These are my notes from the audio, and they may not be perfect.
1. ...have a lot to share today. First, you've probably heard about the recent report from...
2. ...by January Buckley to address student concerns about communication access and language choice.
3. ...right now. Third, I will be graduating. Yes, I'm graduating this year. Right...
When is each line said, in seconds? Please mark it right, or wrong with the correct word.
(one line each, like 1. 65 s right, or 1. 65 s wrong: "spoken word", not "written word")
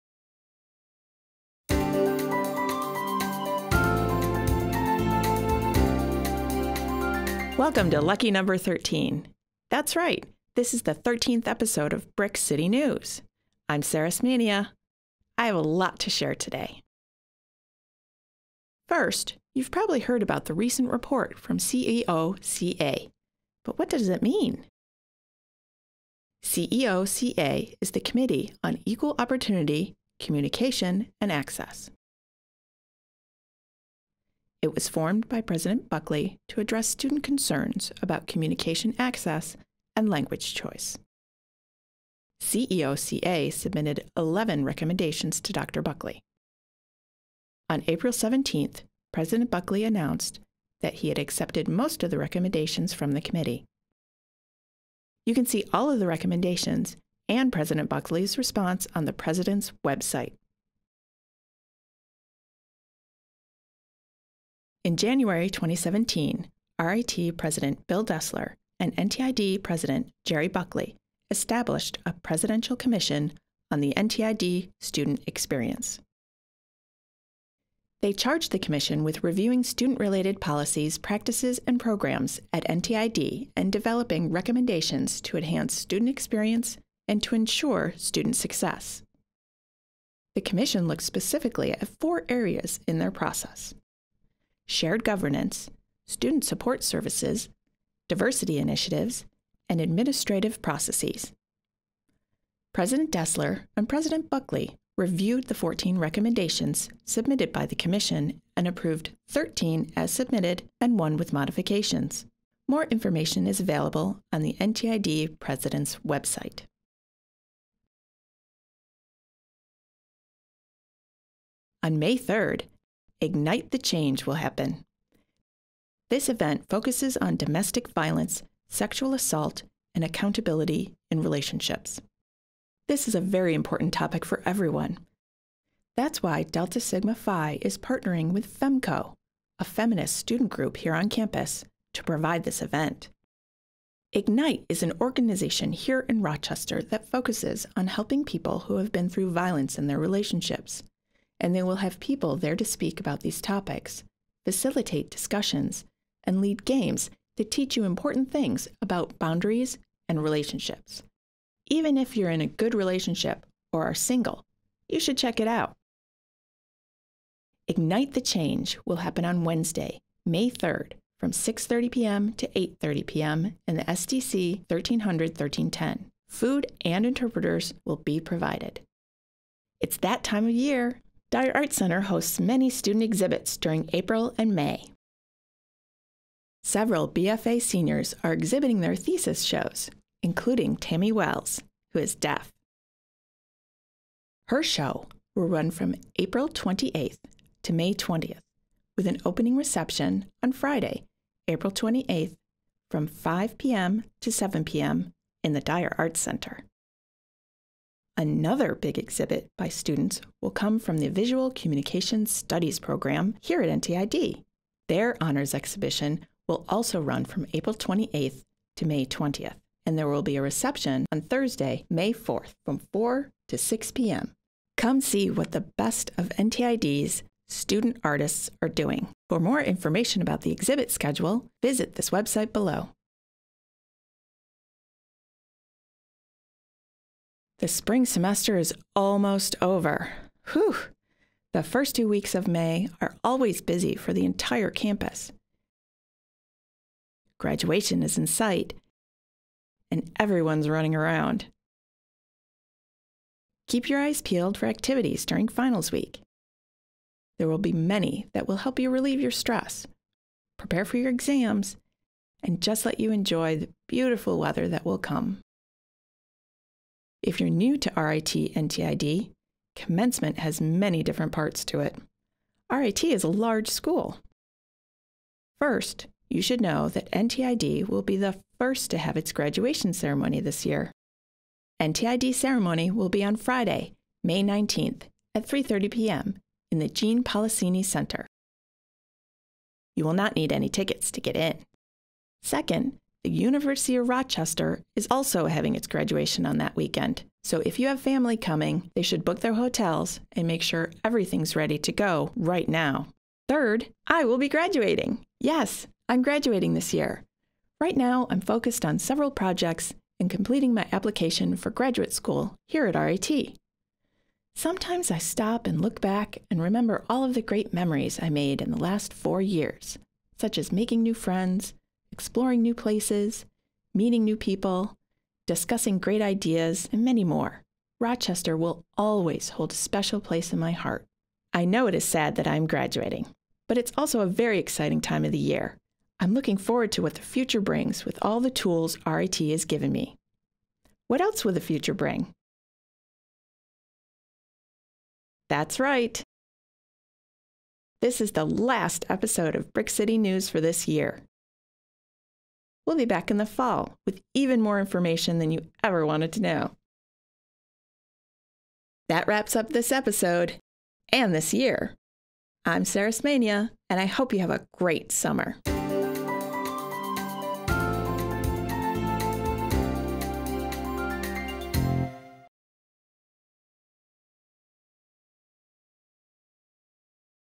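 1. 15 s right
2. 35 s wrong: "President", not "January"
3. 302 s right.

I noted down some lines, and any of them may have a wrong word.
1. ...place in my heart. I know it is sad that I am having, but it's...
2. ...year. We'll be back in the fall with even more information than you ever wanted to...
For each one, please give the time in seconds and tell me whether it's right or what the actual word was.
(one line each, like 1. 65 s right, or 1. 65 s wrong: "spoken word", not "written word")
1. 330 s wrong: "graduating", not "having"
2. 350 s right.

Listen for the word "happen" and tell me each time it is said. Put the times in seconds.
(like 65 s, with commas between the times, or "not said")
124 s, 168 s.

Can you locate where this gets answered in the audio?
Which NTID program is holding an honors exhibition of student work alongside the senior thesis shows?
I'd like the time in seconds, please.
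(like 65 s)
211 s.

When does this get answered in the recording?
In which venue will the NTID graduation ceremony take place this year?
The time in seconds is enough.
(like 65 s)
286 s.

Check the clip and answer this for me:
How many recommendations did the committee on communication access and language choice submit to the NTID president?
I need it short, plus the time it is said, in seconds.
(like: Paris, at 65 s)
11, at 44 s.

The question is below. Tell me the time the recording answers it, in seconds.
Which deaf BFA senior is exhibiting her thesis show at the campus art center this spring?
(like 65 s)
190 s.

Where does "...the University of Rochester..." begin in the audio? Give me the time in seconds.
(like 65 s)
293 s.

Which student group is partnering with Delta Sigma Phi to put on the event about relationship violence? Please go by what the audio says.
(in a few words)
FEMCO.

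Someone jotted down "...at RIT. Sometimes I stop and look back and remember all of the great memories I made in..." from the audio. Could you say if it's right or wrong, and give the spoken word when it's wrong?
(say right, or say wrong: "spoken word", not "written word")
right.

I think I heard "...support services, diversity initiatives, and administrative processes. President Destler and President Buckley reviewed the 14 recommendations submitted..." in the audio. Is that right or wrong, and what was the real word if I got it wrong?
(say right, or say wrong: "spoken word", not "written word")
right.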